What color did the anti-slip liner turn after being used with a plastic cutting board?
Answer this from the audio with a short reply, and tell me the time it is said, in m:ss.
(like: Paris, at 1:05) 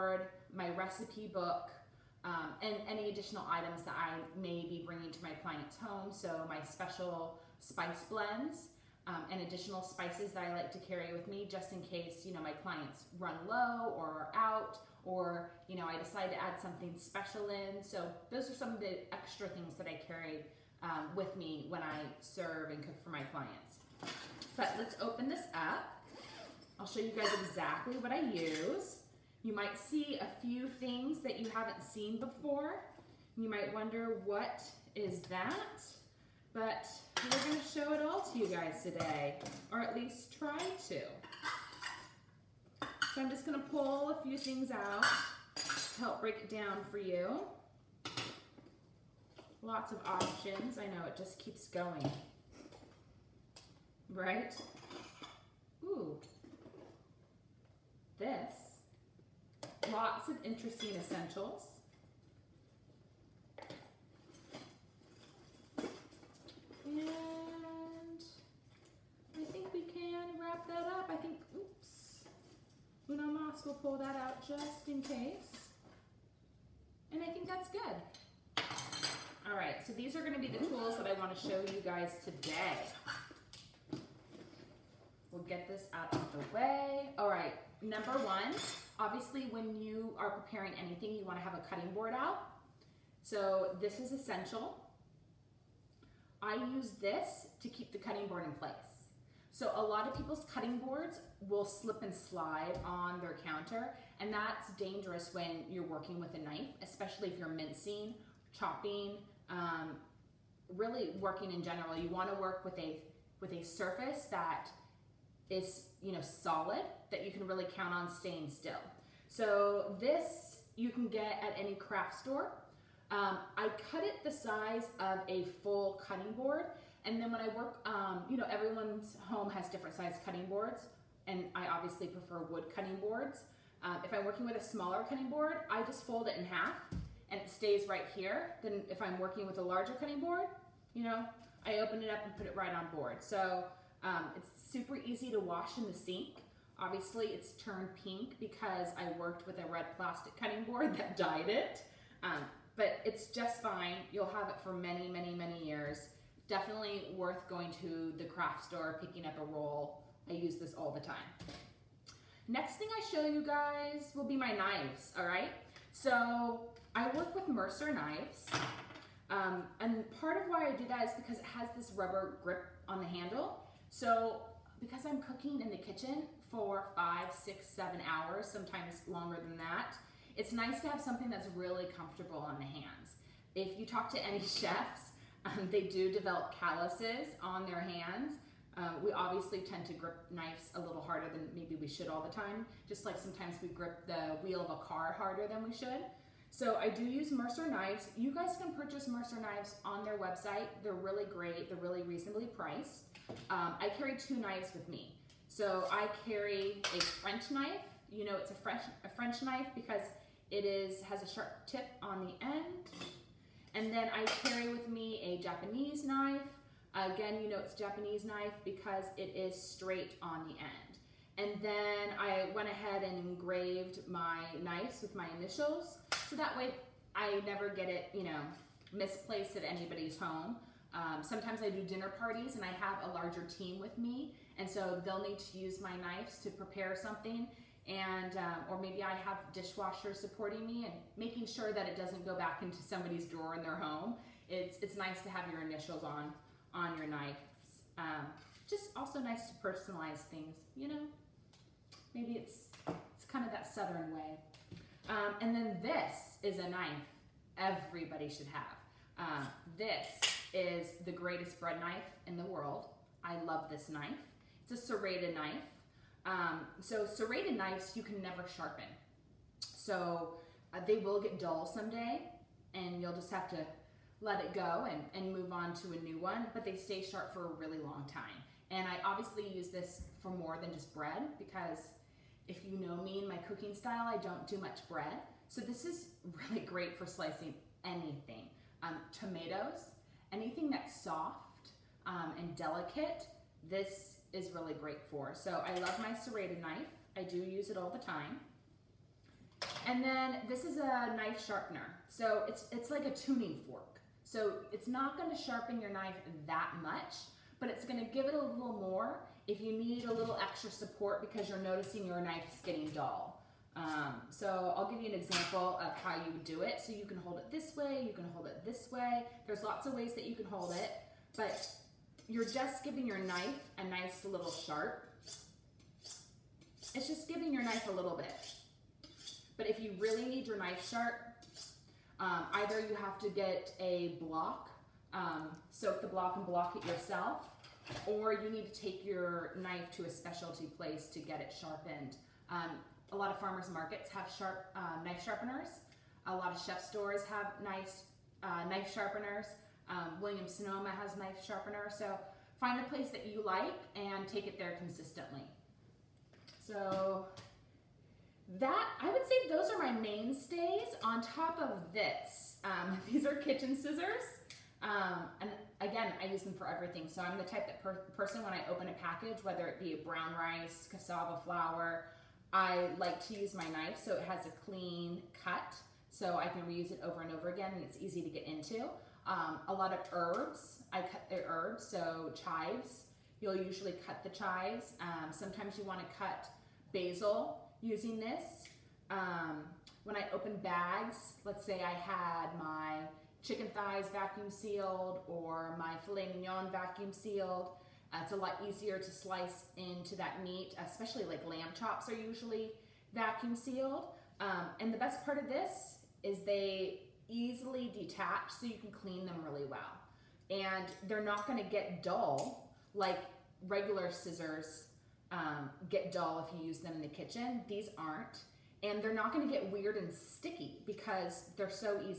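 Pink, at 2:28.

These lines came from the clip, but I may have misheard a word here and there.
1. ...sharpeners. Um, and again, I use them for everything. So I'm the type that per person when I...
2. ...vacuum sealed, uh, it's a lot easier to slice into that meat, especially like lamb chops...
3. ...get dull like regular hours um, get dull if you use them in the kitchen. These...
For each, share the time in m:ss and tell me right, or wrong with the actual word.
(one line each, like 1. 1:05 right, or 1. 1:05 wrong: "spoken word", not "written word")
1. 6:03 wrong: "scissors", not "sharpeners"
2. 6:36 right
3. 6:51 wrong: "scissors", not "hours".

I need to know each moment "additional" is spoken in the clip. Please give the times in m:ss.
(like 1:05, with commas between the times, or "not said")
0:03, 0:09.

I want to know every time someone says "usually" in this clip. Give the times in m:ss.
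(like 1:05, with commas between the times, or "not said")
6:23, 6:42.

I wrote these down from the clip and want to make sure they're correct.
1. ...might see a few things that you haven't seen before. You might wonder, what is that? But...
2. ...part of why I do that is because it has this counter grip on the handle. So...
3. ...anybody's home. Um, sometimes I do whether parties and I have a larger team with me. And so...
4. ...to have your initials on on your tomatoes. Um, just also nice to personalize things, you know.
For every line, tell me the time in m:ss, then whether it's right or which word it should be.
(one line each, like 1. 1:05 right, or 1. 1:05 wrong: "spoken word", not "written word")
1. 0:29 right
2. 2:50 wrong: "rubber", not "counter"
3. 3:49 wrong: "dinner", not "whether"
4. 4:05 wrong: "knives", not "tomatoes".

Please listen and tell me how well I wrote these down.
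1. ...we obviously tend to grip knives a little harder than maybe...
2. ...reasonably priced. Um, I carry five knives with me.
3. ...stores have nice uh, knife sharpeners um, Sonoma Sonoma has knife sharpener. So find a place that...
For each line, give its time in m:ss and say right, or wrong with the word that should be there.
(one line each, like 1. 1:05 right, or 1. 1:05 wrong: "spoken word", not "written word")
1. 3:09 right
2. 3:22 wrong: "two", not "five"
3. 5:46 wrong: "William", not "Sonoma".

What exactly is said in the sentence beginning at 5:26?
It's just giving your knife a little bit.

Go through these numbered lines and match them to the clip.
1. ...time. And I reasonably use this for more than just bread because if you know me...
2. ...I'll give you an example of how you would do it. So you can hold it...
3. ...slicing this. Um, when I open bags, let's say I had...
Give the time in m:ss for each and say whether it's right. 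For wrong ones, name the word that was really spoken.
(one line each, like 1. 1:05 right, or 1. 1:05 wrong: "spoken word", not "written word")
1. 4:38 wrong: "obviously", not "reasonably"
2. 5:14 right
3. 6:27 wrong: "using", not "slicing".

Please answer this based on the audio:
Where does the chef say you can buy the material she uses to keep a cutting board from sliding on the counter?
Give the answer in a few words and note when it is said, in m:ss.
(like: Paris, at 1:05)
Any craft store, at 2:01.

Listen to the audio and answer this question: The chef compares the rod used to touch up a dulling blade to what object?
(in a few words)
A tuning fork.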